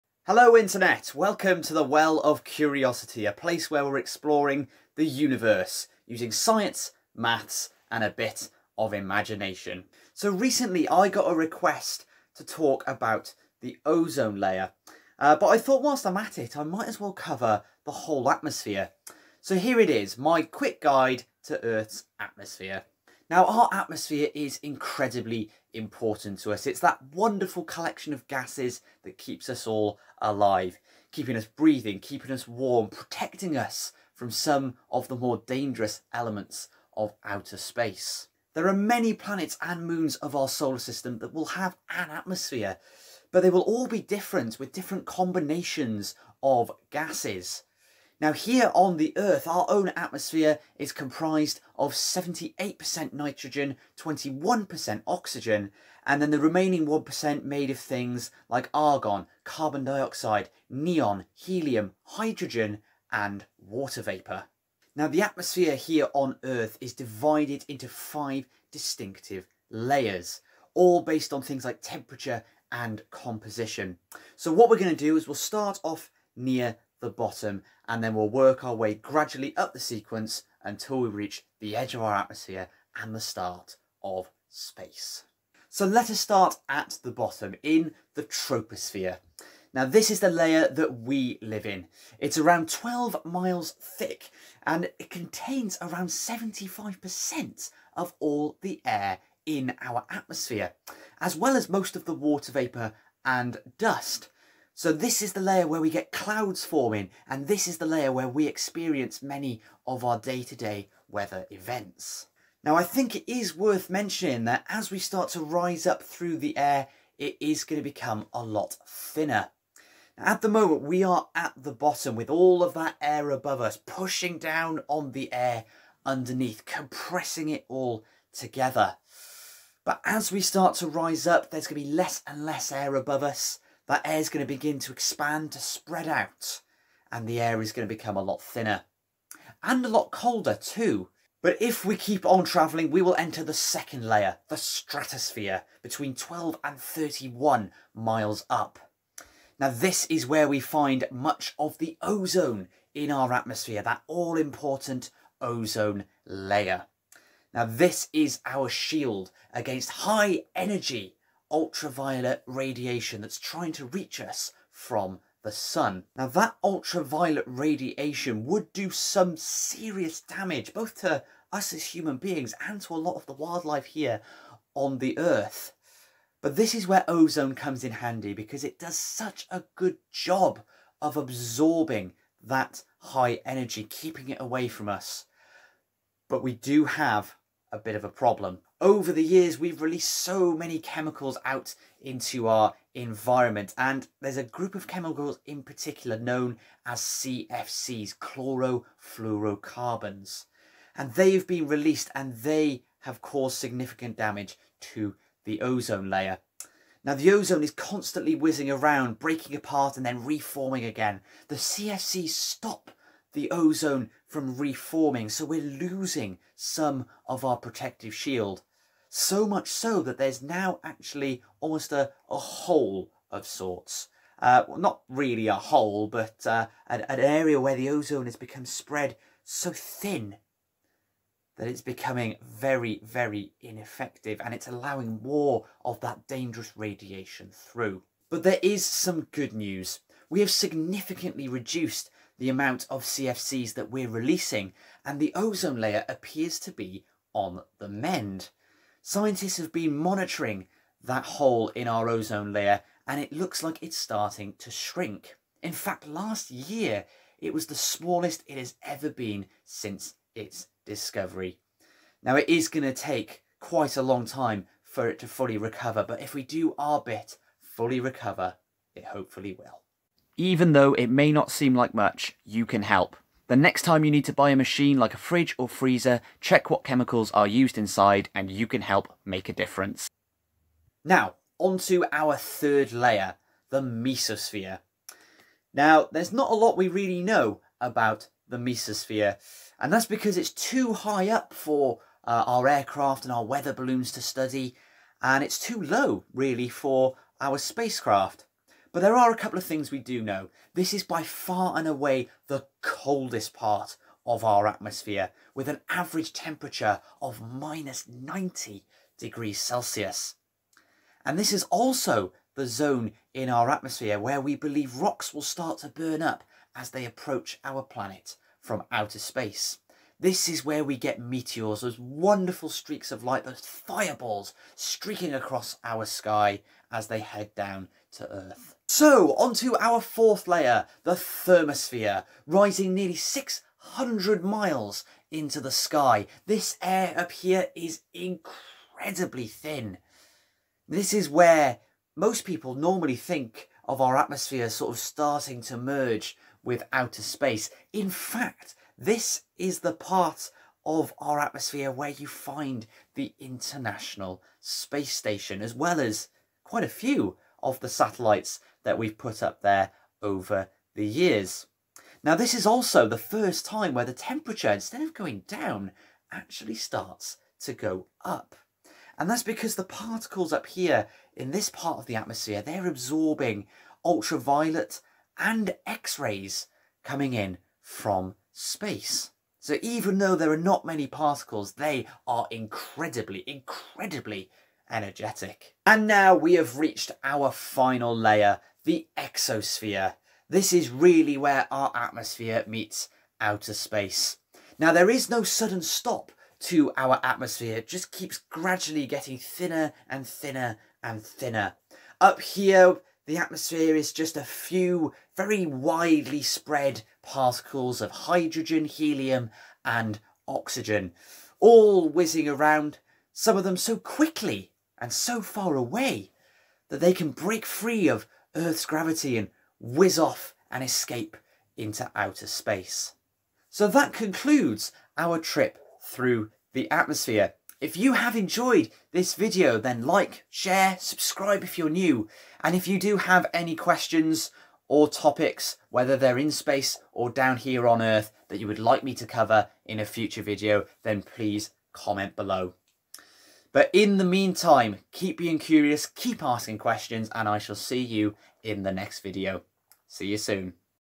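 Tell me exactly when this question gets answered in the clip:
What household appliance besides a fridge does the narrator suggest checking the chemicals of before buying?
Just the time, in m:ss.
4:35.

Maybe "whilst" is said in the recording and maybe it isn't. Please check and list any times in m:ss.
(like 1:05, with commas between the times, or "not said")
0:15.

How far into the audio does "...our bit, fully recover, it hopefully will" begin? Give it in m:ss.
4:26.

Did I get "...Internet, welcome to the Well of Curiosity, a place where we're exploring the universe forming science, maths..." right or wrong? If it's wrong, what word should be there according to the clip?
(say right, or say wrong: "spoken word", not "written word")
wrong: "using", not "forming".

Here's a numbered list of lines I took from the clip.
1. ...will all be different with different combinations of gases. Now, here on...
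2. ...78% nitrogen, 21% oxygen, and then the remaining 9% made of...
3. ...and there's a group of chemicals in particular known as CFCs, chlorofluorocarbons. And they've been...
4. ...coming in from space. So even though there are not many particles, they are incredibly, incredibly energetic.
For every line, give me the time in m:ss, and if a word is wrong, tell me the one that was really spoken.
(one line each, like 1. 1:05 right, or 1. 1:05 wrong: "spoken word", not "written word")
1. 0:43 right
2. 0:51 wrong: "1", not "9"
3. 3:13 right
4. 6:17 right.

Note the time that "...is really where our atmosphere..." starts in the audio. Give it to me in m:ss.
6:30.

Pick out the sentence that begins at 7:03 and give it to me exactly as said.
So that concludes our trip through the atmosphere.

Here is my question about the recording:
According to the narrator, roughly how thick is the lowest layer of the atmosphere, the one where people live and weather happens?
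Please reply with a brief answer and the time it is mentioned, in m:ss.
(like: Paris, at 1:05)
12 miles, at 1:32.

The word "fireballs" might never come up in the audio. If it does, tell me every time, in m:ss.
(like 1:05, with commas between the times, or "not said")
5:23.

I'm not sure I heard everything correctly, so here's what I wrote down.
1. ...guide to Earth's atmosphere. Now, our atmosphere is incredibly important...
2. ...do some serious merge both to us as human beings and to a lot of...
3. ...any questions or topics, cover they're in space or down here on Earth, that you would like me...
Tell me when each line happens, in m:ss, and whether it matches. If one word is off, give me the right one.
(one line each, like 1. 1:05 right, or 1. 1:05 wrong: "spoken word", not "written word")
1. 0:20 right
2. 2:48 wrong: "damage", not "merge"
3. 7:13 wrong: "whether", not "cover".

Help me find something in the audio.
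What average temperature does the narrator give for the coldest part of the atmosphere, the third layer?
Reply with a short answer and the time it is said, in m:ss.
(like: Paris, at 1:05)
-90 degrees Celsius, at 5:07.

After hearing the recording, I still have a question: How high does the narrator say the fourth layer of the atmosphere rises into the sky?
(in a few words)
nearly 600 miles.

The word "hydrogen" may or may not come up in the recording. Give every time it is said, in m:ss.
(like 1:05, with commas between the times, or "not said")
1:02, 6:48.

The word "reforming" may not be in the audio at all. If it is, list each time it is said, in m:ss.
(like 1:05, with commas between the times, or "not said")
3:30, 3:34.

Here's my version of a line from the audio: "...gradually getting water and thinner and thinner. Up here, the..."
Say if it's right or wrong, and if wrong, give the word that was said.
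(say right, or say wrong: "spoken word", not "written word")
wrong: "thinner", not "water".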